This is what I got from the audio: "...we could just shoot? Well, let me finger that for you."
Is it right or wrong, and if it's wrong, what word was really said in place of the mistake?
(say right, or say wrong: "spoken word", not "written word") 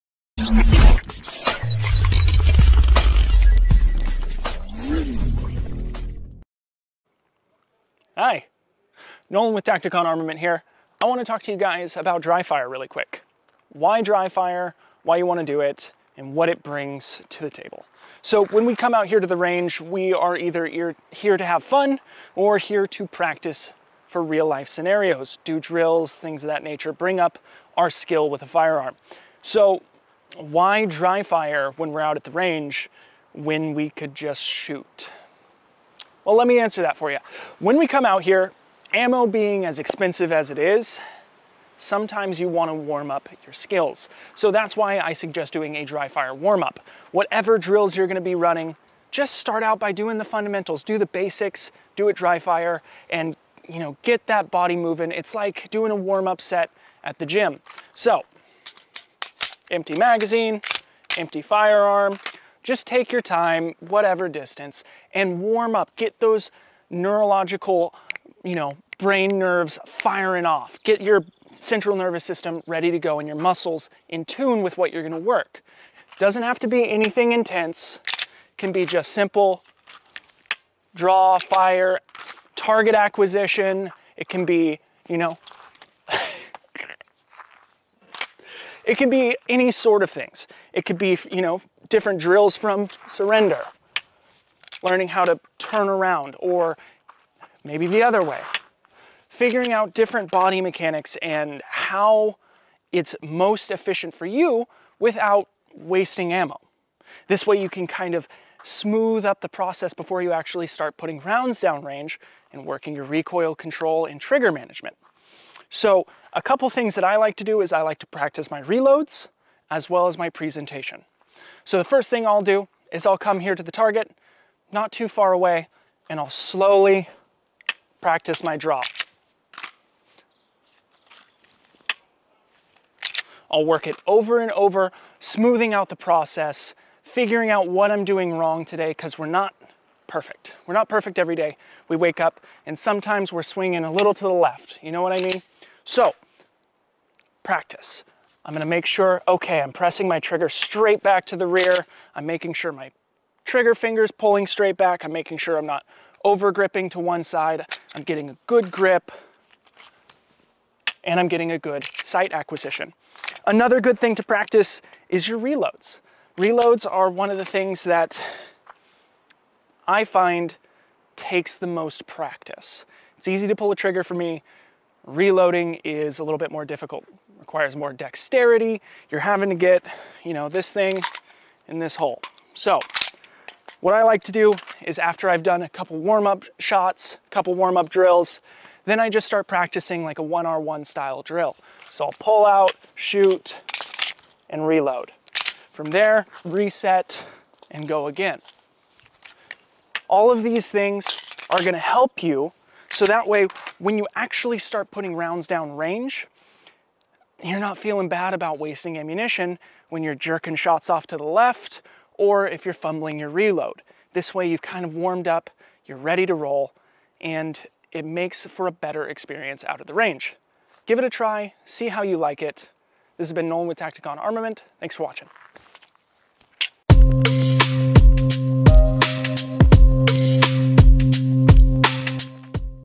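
wrong: "answer", not "finger".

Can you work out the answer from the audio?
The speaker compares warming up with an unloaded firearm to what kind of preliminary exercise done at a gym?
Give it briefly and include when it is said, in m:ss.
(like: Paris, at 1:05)
warm up set, at 0:55.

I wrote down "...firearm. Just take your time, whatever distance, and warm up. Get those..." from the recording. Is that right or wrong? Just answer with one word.
right.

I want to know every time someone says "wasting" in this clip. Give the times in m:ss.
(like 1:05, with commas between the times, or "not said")
1:45, 3:28.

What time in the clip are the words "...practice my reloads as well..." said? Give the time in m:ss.
1:58.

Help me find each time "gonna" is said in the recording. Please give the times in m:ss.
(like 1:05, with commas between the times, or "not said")
1:15, 2:28, 3:21.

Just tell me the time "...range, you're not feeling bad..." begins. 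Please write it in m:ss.
3:25.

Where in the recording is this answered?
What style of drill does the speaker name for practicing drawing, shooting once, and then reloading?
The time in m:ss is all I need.
3:10.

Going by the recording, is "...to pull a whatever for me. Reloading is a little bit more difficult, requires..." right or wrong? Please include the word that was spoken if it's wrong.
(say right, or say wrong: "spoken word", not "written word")
wrong: "trigger", not "whatever".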